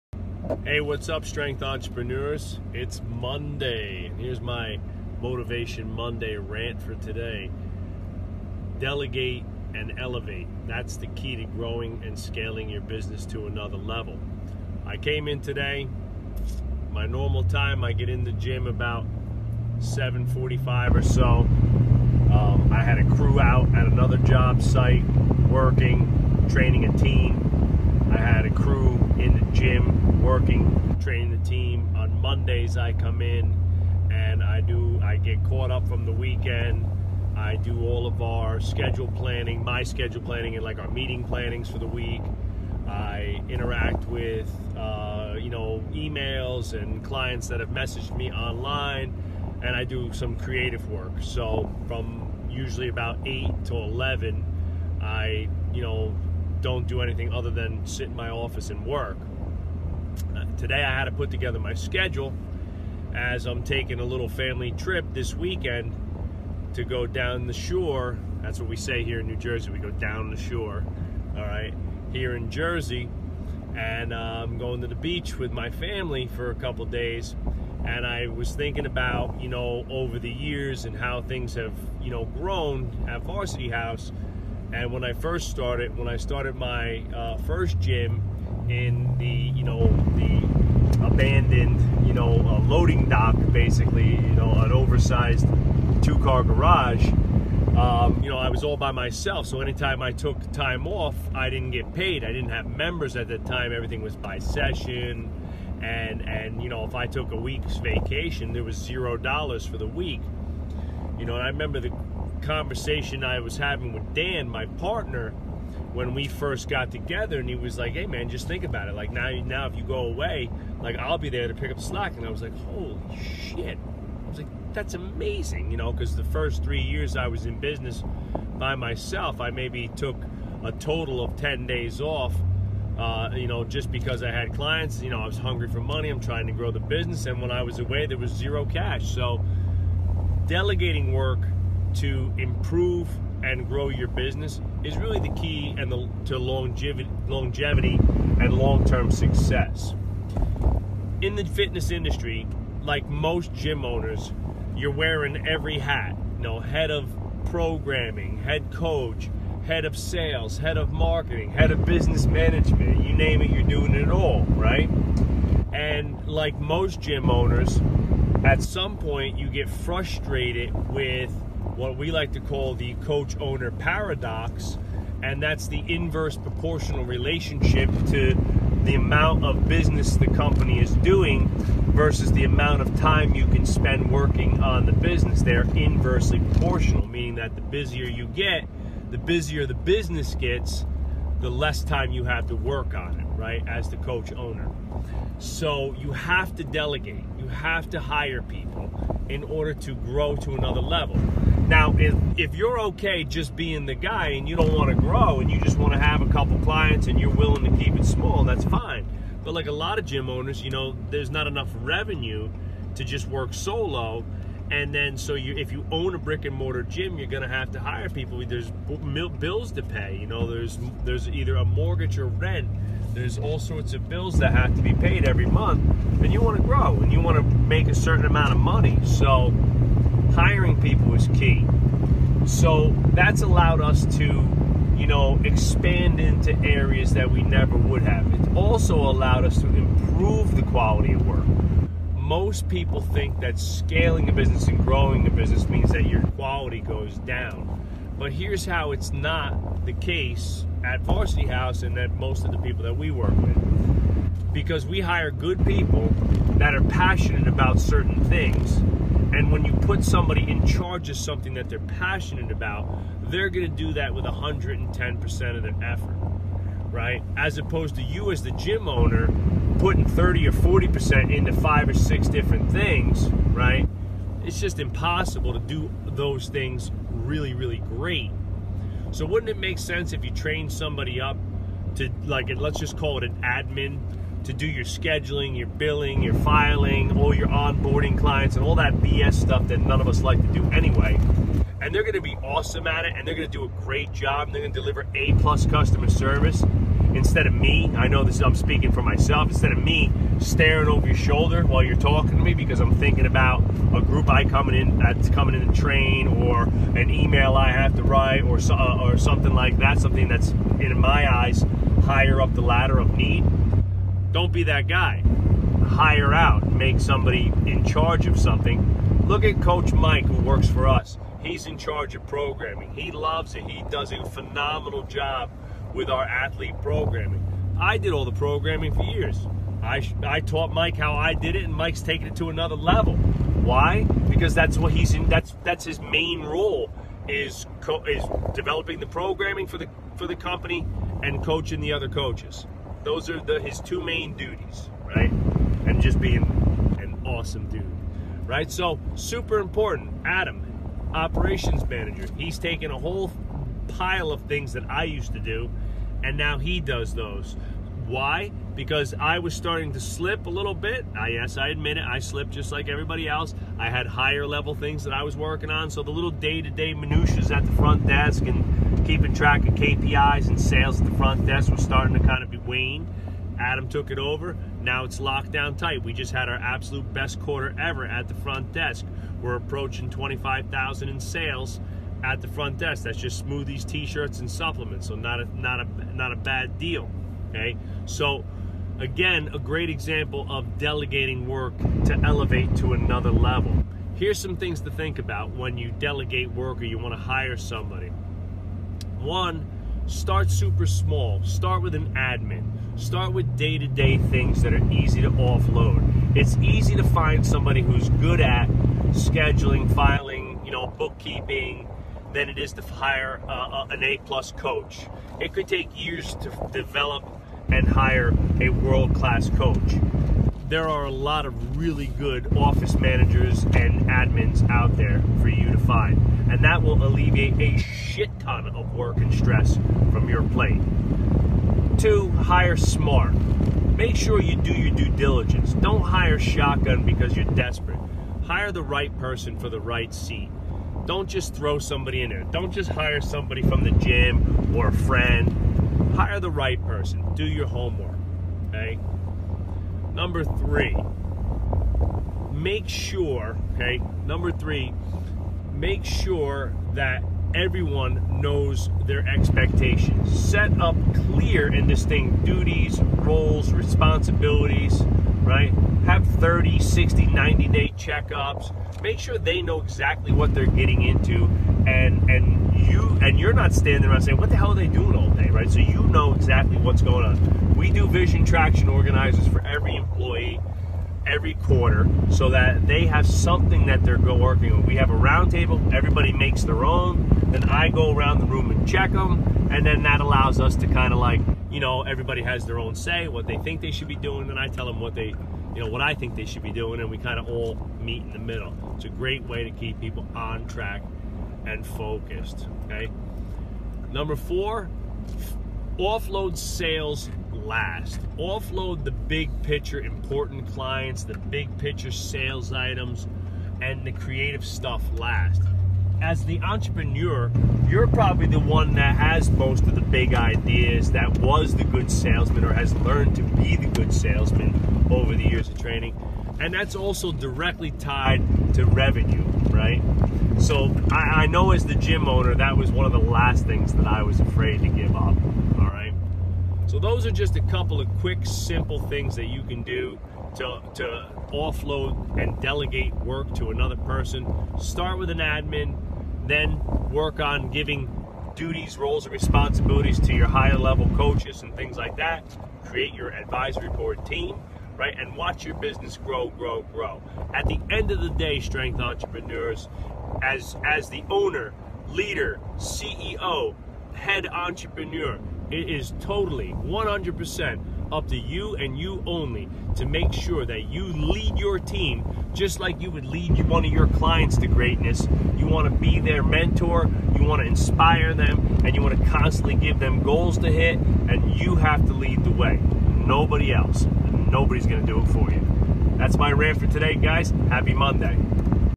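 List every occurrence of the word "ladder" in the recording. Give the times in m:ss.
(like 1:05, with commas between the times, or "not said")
5:12.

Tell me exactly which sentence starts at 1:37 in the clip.
Um, you know, I was all by myself, so anytime I took time off, I didn't get paid.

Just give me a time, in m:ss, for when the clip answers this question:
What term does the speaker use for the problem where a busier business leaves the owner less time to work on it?
2:52.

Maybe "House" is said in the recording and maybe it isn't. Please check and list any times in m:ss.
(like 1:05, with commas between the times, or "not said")
1:23, 4:11.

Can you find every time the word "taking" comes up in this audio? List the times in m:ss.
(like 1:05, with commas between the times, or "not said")
1:03, 5:32.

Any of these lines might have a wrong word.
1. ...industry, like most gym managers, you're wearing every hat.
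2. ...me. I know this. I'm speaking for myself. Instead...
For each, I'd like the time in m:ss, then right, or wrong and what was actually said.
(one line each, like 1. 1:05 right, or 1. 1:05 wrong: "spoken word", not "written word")
1. 2:31 wrong: "owners", not "managers"
2. 4:57 right.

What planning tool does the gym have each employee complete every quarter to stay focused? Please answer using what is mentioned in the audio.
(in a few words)
vision traction organizers.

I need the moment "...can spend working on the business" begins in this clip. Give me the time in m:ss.
3:03.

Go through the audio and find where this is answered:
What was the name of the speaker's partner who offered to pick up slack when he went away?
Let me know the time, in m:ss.
1:54.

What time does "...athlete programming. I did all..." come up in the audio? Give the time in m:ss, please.
5:26.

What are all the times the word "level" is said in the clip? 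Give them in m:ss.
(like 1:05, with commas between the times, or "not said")
0:13, 3:20, 5:32, 6:04, 6:33, 9:10.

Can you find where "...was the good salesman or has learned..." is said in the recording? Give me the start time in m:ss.
8:41.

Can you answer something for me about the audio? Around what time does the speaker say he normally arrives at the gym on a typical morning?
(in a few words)
7:45.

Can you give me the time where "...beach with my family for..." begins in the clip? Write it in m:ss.
1:14.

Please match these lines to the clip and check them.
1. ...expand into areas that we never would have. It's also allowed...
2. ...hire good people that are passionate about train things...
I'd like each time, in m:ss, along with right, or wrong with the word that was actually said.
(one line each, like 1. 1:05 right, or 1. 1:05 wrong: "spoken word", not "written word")
1. 3:55 right
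2. 4:15 wrong: "certain", not "train".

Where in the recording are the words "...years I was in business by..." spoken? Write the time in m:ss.
2:06.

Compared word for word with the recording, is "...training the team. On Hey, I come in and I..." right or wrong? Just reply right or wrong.
wrong.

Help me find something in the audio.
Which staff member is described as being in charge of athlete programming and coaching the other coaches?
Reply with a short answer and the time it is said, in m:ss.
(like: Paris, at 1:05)
Coach Mike, at 5:19.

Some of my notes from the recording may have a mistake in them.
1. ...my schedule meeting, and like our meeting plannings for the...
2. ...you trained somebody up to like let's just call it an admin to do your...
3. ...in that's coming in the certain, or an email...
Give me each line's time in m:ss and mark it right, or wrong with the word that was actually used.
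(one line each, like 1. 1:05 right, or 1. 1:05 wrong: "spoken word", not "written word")
1. 0:39 wrong: "planning", not "meeting"
2. 4:40 right
3. 5:04 wrong: "train", not "certain".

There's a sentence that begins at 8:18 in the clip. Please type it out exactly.
It's a great way to keep people on track and focused, okay?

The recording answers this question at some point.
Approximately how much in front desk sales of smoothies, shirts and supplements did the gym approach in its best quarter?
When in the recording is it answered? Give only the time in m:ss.
6:20.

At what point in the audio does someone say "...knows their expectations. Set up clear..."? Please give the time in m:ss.
7:38.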